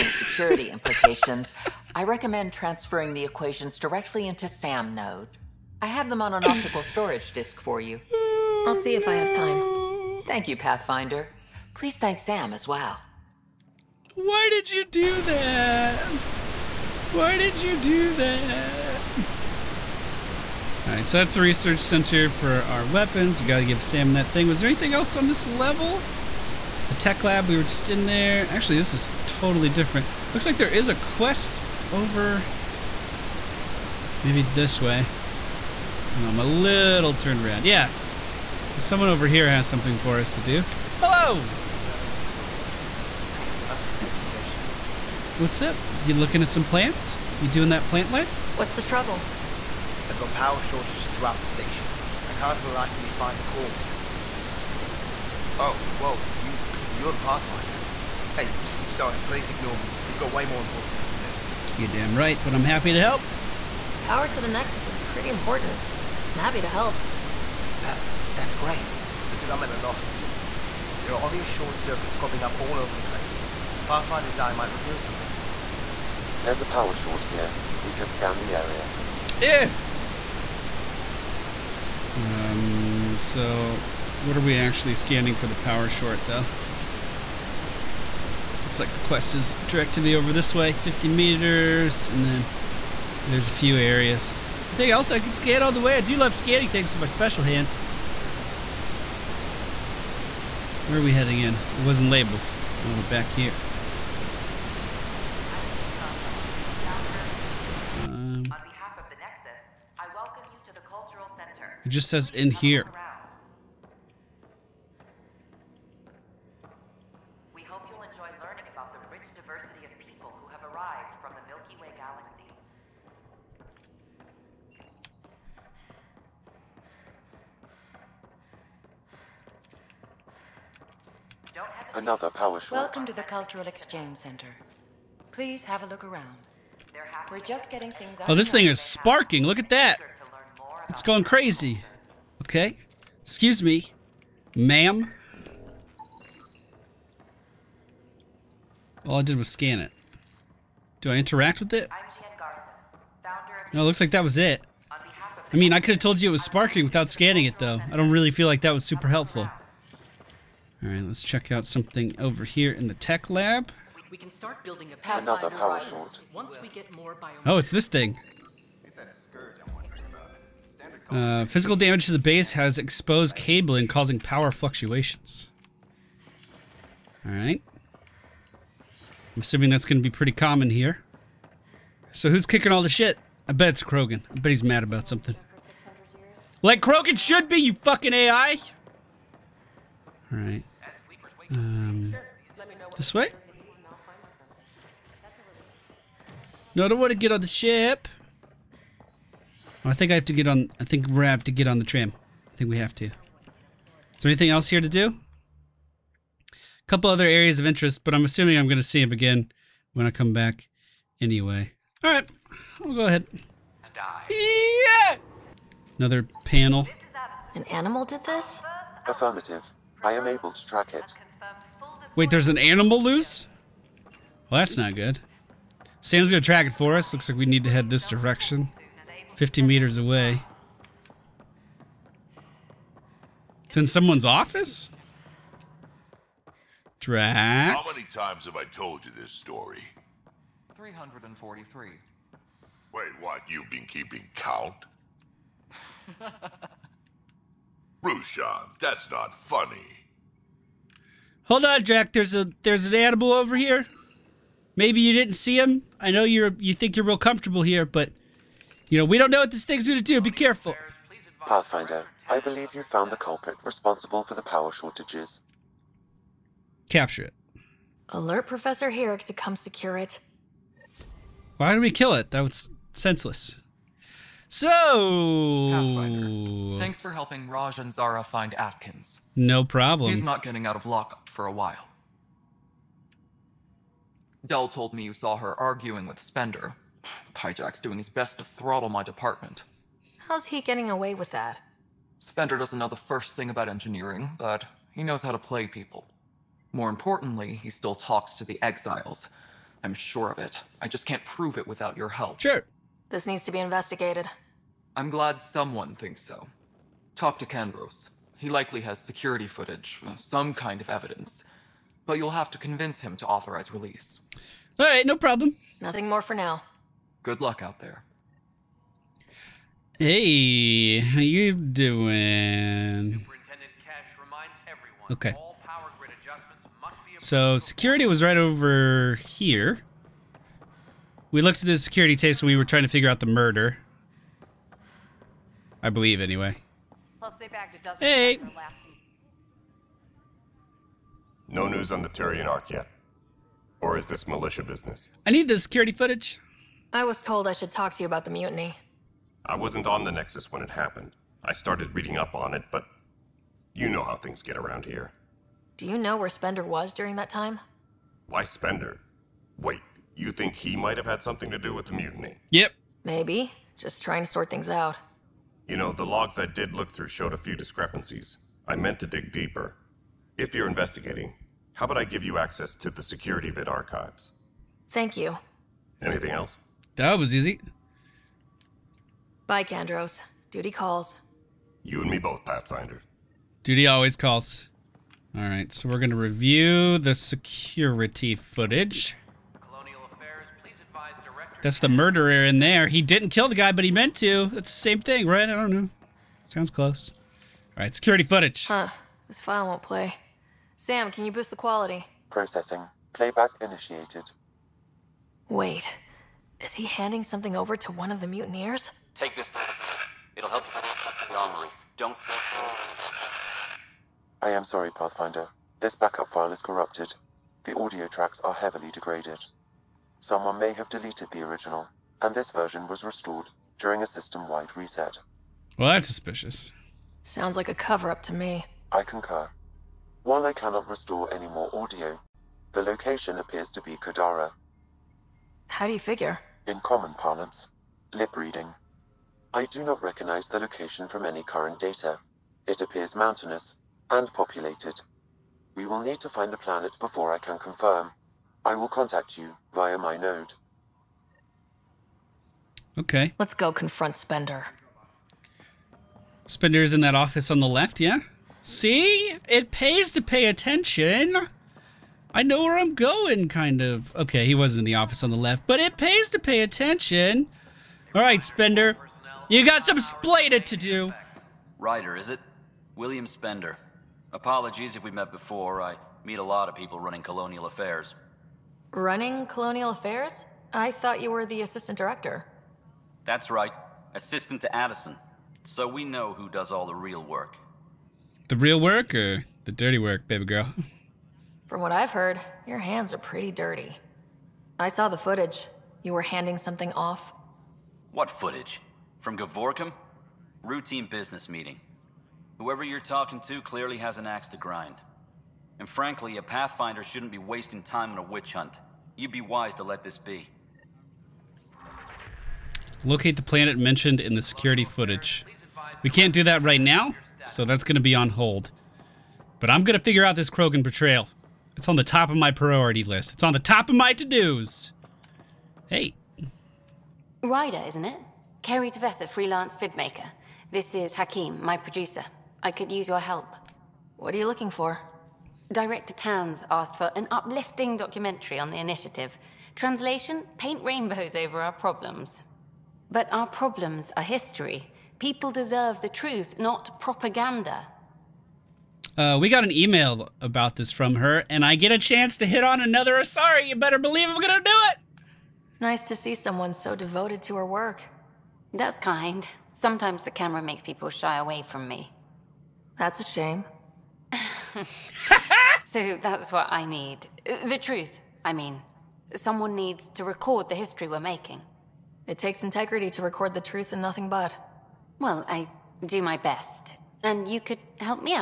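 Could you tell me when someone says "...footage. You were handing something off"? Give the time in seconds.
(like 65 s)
495 s.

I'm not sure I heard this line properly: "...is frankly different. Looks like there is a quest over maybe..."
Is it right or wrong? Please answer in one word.
wrong.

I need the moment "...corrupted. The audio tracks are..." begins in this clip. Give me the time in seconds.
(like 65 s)
416 s.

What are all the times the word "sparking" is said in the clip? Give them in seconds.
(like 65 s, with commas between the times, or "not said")
138 s, 156 s.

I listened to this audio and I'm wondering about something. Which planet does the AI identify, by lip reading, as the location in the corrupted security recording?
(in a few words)
Kadara.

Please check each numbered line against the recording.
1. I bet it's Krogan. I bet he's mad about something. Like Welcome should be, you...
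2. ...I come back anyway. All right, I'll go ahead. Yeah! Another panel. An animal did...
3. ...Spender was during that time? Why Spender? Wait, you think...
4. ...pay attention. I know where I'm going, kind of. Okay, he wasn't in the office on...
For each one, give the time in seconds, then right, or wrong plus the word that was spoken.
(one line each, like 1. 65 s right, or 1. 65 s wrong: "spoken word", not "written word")
1. 183 s wrong: "Krogan", not "Welcome"
2. 210 s right
3. 356 s right
4. 460 s right.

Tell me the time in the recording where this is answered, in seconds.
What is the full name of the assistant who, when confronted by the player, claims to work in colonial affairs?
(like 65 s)
472 s.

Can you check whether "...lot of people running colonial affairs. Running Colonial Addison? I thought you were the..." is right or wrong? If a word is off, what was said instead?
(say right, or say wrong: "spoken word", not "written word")
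wrong: "Affairs", not "Addison".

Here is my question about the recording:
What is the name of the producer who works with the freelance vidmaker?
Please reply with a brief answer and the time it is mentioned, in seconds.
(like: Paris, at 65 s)
Hakim, at 531 s.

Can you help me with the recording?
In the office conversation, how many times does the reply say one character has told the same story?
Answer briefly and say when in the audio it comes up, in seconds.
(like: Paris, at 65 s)
343, at 240 s.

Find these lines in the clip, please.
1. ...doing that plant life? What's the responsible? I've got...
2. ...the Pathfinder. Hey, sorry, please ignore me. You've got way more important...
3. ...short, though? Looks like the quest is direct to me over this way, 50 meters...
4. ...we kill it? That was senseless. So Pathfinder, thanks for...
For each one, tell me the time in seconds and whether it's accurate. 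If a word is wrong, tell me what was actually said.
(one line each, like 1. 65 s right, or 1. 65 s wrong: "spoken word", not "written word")
1. 47 s wrong: "trouble", not "responsible"
2. 57 s right
3. 85 s right
4. 271 s right.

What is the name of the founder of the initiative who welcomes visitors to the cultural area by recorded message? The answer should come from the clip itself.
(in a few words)
Jien Garson.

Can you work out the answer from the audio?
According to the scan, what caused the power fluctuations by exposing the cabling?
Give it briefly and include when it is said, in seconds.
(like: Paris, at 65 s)
Physical damage to the base, at 171 s.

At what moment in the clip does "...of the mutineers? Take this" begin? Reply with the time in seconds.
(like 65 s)
408 s.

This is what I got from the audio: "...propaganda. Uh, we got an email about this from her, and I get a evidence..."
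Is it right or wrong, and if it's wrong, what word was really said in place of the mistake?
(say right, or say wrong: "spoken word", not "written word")
wrong: "chance", not "evidence".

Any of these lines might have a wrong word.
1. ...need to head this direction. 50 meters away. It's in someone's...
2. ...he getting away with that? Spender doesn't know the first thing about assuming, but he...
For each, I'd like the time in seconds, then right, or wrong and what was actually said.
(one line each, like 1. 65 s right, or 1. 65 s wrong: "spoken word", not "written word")
1. 227 s right
2. 290 s wrong: "engineering", not "assuming".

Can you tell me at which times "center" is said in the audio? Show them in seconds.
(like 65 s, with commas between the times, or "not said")
21 s, 111 s, 134 s.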